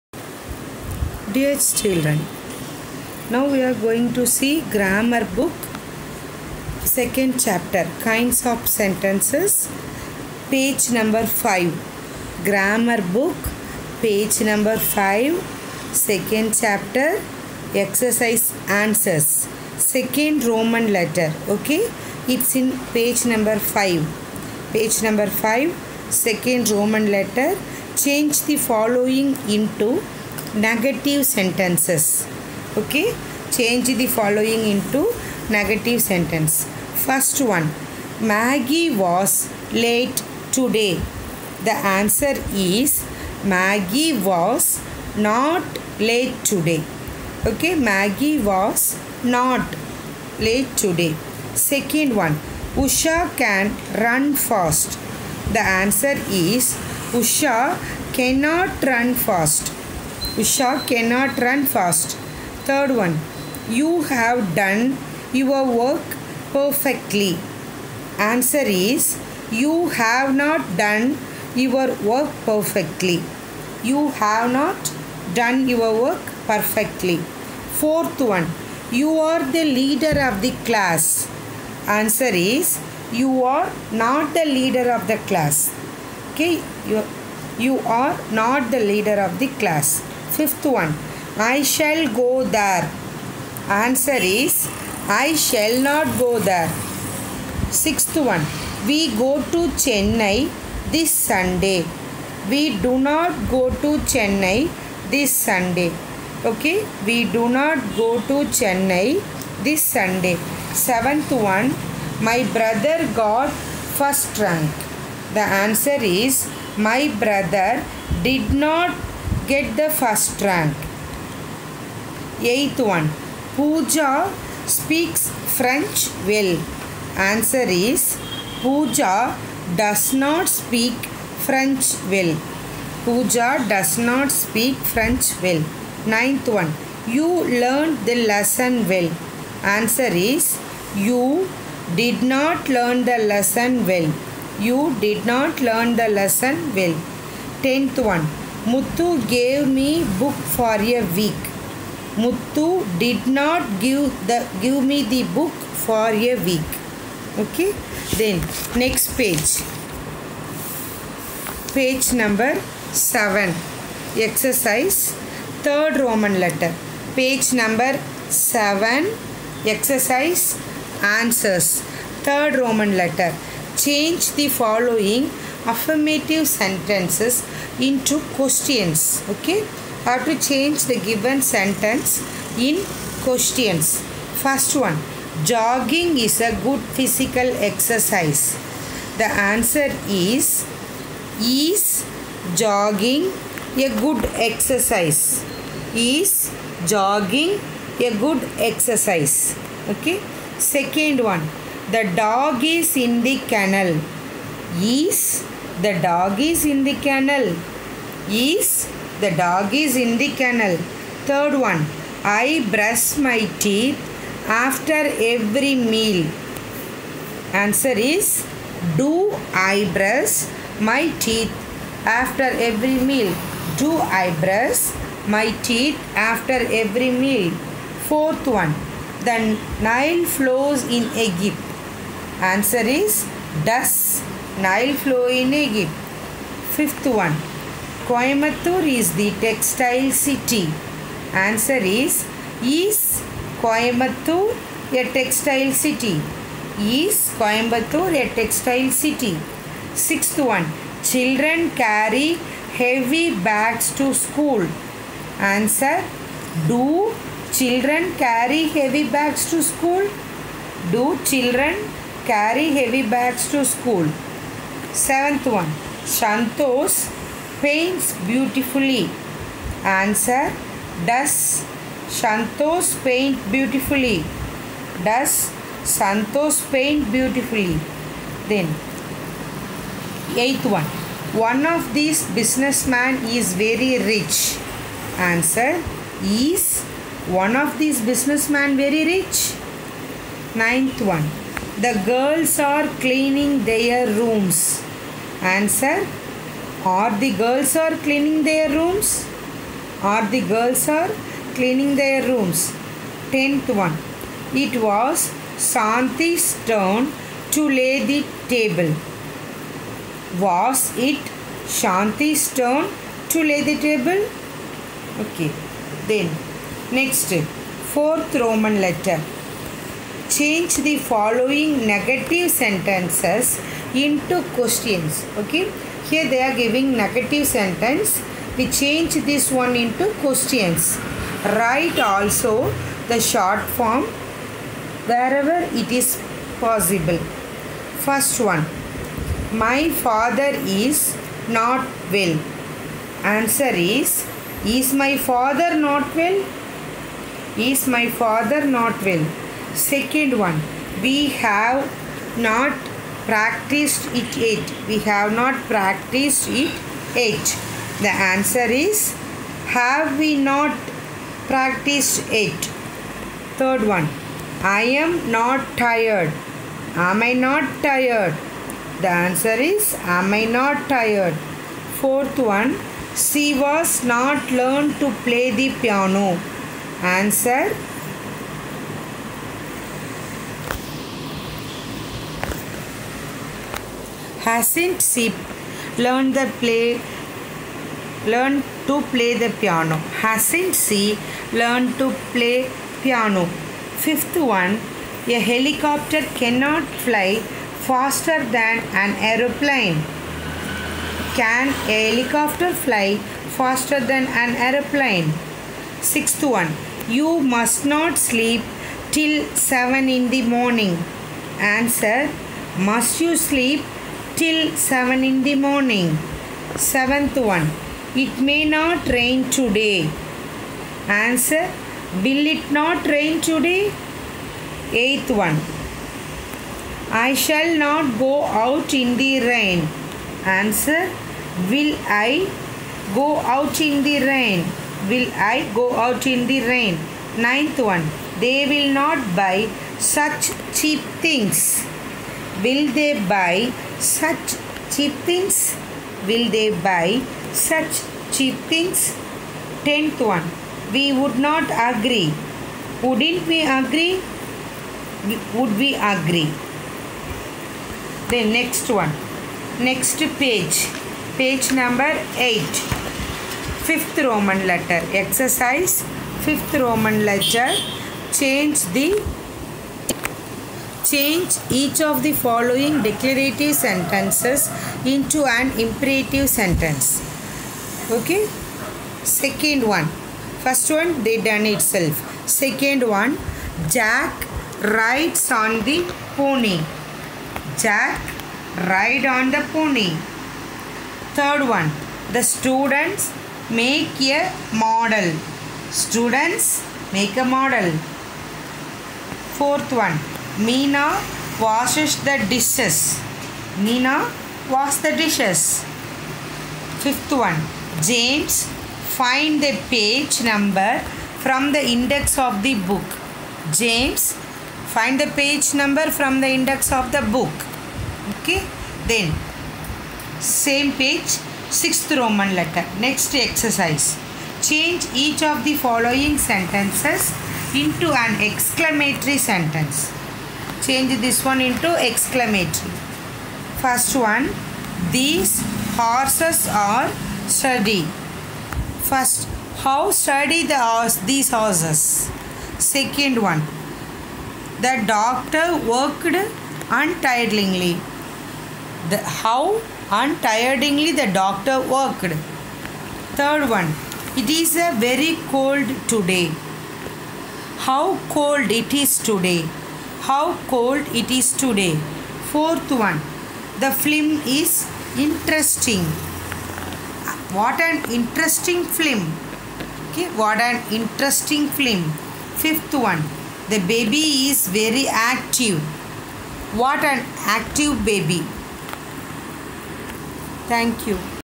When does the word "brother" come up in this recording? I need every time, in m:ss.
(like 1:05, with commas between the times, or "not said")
1:52, 1:57.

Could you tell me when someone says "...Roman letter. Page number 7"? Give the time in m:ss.
2:45.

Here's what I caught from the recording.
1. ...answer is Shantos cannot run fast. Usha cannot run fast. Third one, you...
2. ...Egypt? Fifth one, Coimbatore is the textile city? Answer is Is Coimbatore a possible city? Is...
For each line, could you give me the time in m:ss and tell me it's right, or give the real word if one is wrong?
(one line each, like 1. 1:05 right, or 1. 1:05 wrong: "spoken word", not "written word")
1. 0:55 wrong: "Usha", not "Shantos"
2. 3:55 wrong: "textile", not "possible".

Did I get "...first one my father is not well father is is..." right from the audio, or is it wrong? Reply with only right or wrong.
wrong.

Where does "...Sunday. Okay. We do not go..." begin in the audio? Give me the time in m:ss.
1:45.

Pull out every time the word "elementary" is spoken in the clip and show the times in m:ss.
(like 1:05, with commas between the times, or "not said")
not said.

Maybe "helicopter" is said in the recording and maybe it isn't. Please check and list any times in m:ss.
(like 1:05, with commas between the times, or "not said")
6:35, 6:42.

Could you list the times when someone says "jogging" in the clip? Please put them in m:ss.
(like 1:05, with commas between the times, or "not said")
3:05, 3:12, 3:16.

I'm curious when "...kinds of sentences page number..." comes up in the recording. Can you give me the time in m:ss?
0:08.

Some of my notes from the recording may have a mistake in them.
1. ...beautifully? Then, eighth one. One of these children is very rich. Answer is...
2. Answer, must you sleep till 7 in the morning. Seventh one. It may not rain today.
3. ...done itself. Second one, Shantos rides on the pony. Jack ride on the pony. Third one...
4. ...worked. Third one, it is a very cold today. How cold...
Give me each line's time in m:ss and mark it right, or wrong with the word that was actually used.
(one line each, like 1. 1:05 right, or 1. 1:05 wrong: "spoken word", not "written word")
1. 4:37 wrong: "businessmen", not "children"
2. 6:51 right
3. 8:01 wrong: "Jack", not "Shantos"
4. 9:11 right.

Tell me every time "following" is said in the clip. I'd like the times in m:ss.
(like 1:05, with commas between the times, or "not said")
0:28, 0:34, 2:54, 5:20, 7:52, 8:45.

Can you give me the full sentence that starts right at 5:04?
It was Shanti's turn to lay the table.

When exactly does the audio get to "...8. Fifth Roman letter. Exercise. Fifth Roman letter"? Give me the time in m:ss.
7:42.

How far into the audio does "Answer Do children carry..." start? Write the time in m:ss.
4:15.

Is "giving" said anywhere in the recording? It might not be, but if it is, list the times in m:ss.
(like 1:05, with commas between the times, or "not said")
5:26.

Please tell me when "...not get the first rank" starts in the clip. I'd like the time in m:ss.
1:58.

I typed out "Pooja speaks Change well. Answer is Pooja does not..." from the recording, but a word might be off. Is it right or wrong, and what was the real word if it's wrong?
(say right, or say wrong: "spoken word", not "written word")
wrong: "French", not "Change".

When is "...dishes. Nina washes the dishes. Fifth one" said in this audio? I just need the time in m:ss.
8:22.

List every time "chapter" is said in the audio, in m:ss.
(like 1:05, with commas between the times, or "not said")
0:07, 0:16.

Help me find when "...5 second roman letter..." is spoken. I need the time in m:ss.
0:25.